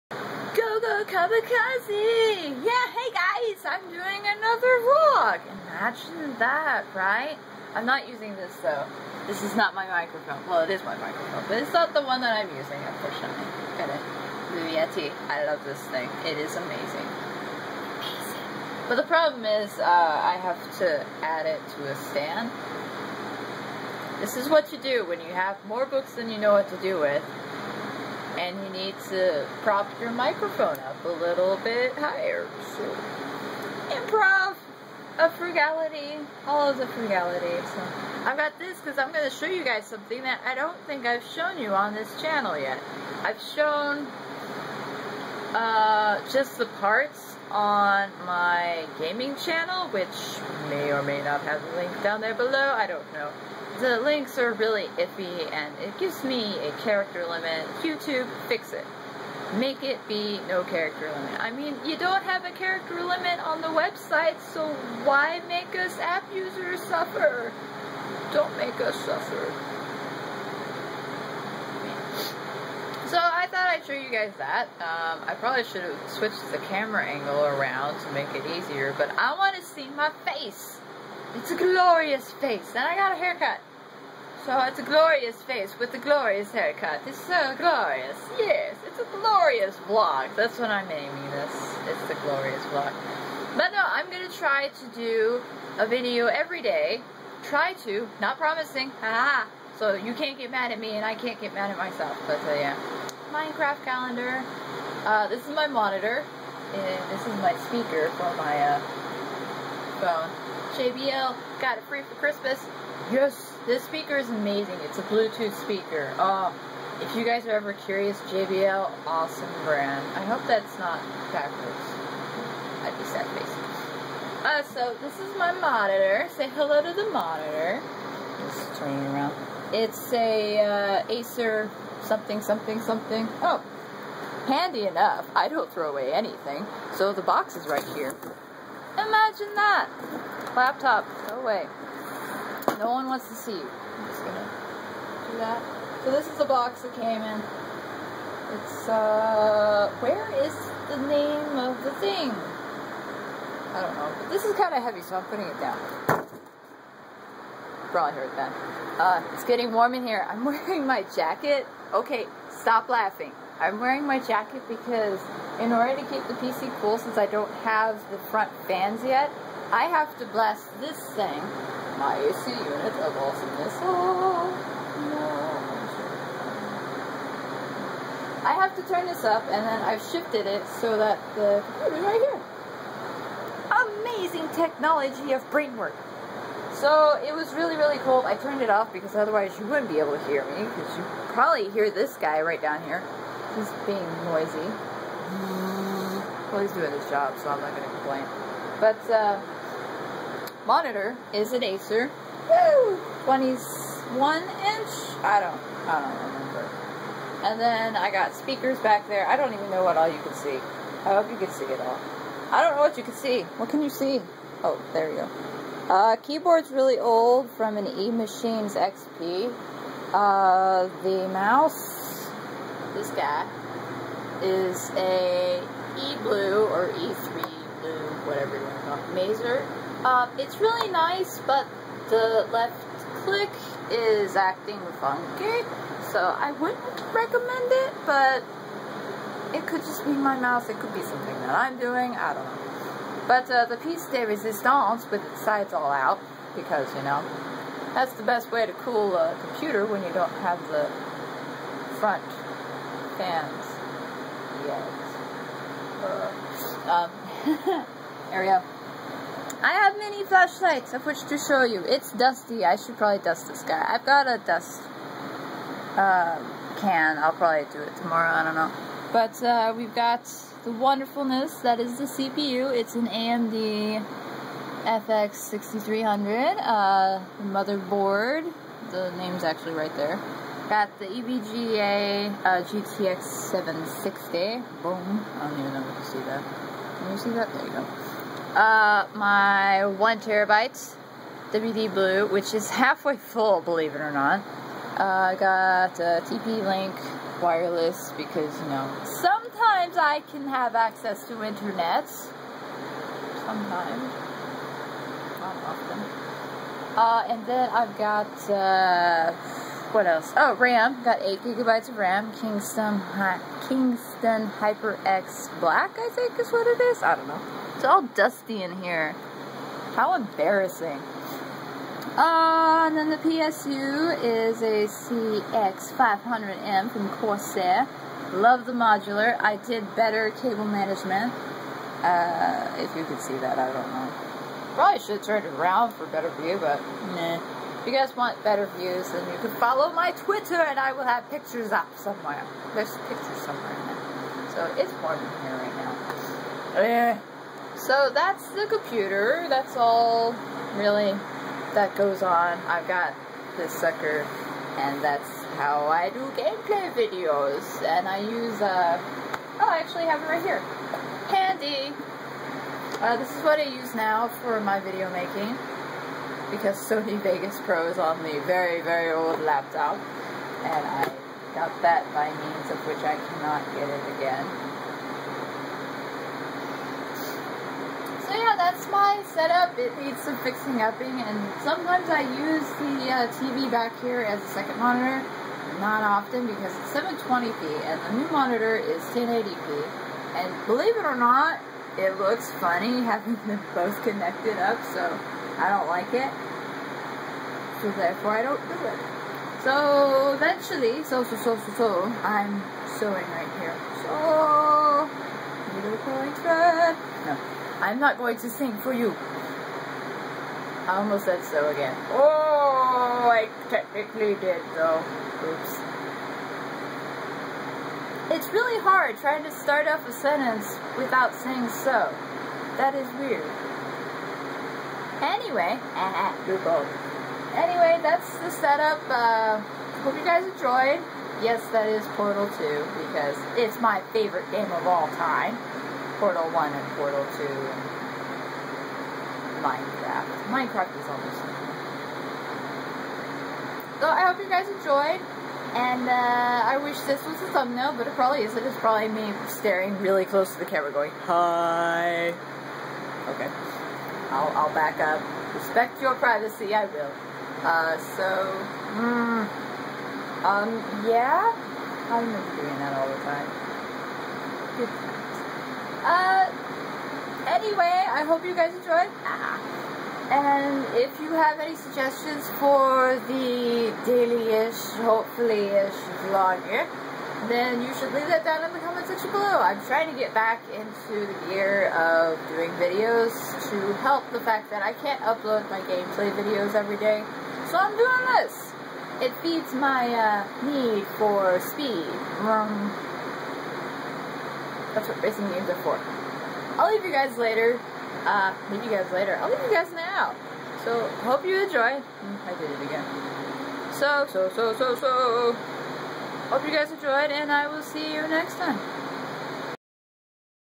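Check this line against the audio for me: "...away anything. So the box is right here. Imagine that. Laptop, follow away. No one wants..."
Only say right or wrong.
wrong.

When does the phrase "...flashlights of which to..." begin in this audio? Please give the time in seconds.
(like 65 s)
260 s.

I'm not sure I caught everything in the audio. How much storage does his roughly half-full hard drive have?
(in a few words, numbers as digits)
1 terabyte.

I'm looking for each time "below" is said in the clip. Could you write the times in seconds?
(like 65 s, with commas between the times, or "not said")
52 s, 479 s.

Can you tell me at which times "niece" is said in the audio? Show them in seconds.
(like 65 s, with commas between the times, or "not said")
not said.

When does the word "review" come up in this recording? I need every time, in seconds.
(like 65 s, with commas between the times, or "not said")
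not said.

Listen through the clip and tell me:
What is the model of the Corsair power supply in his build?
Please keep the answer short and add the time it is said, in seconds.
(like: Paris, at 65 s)
CX500M, at 324 s.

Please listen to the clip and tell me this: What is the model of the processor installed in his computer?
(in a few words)
AMD FX6300.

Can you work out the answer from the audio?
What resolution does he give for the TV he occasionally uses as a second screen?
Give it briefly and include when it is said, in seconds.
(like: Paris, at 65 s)
720p, at 386 s.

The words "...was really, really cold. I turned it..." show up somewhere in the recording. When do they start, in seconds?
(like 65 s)
187 s.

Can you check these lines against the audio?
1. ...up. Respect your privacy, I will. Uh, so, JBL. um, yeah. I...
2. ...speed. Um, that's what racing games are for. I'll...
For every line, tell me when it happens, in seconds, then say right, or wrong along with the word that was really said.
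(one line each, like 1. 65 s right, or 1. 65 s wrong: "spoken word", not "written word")
1. 454 s wrong: "Hmm", not "JBL"
2. 491 s right.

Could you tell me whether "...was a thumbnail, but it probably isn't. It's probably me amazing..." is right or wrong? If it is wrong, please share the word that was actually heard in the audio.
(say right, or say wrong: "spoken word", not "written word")
wrong: "staring", not "amazing".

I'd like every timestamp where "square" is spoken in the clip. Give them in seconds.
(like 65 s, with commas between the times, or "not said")
not said.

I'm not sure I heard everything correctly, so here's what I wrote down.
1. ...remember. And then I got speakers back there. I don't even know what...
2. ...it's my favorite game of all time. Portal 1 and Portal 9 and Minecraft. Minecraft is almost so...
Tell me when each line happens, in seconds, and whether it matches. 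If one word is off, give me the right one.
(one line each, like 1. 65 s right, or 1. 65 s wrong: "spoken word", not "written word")
1. 206 s right
2. 433 s wrong: "2", not "9".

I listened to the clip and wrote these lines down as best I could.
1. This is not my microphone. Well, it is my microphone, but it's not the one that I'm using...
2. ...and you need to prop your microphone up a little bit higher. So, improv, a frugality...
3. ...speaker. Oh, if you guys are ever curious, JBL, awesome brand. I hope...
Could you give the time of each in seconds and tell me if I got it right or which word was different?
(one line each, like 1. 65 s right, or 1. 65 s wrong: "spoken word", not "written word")
1. 9 s right
2. 28 s right
3. 115 s right.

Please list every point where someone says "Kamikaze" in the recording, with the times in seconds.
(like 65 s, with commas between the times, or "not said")
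1 s.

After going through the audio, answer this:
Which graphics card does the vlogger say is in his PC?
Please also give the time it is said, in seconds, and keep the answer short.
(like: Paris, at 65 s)
EVGA GTX 760, at 281 s.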